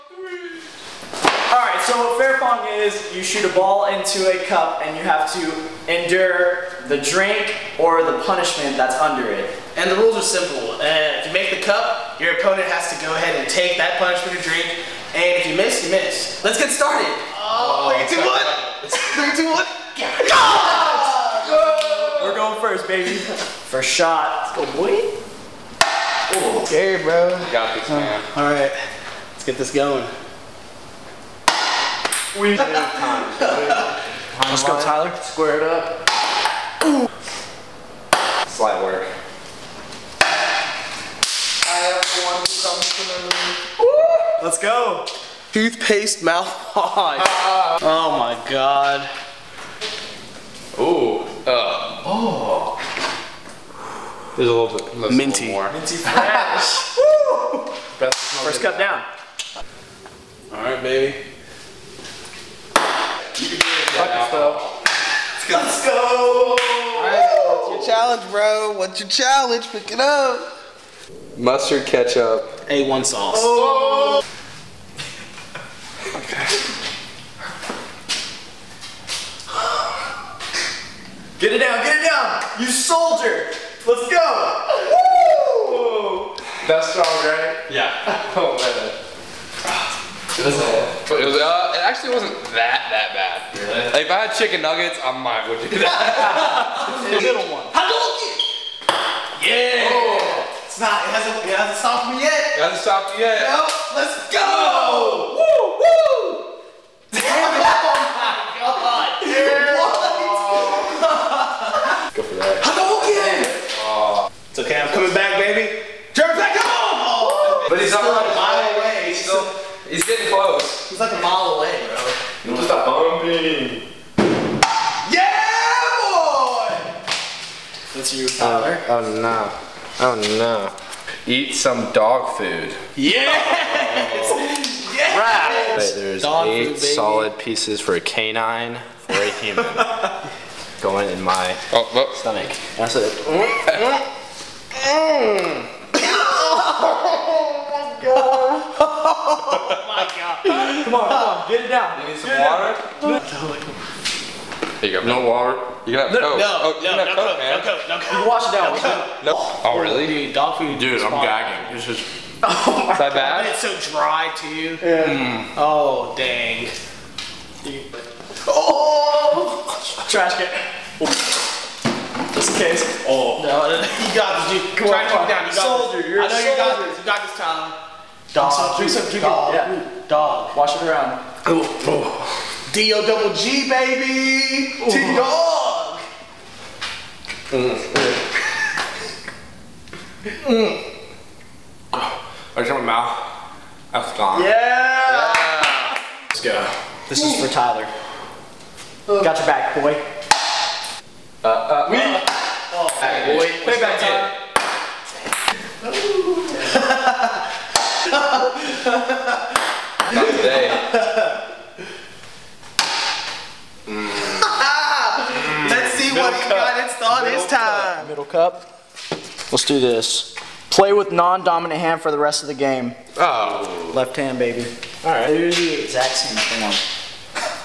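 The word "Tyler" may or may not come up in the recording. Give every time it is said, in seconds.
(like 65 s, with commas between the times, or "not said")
34 s, 128 s, 177 s, 197 s.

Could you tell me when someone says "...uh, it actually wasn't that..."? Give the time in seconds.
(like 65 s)
91 s.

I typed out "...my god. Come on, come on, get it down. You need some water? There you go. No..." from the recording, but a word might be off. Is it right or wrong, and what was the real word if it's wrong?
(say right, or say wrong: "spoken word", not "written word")
right.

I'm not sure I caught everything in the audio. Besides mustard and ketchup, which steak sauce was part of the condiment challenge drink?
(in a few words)
A1 sauce.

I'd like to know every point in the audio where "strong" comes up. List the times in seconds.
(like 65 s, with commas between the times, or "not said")
86 s.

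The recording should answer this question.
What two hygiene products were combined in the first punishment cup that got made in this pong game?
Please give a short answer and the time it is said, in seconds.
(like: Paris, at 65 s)
Toothpaste mouthwash, at 45 s.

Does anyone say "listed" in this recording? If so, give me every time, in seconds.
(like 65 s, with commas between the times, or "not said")
not said.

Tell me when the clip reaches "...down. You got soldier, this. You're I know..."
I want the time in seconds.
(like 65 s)
175 s.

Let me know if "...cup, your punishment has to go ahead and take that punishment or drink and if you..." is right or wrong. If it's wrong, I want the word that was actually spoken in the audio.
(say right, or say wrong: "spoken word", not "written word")
wrong: "opponent", not "punishment".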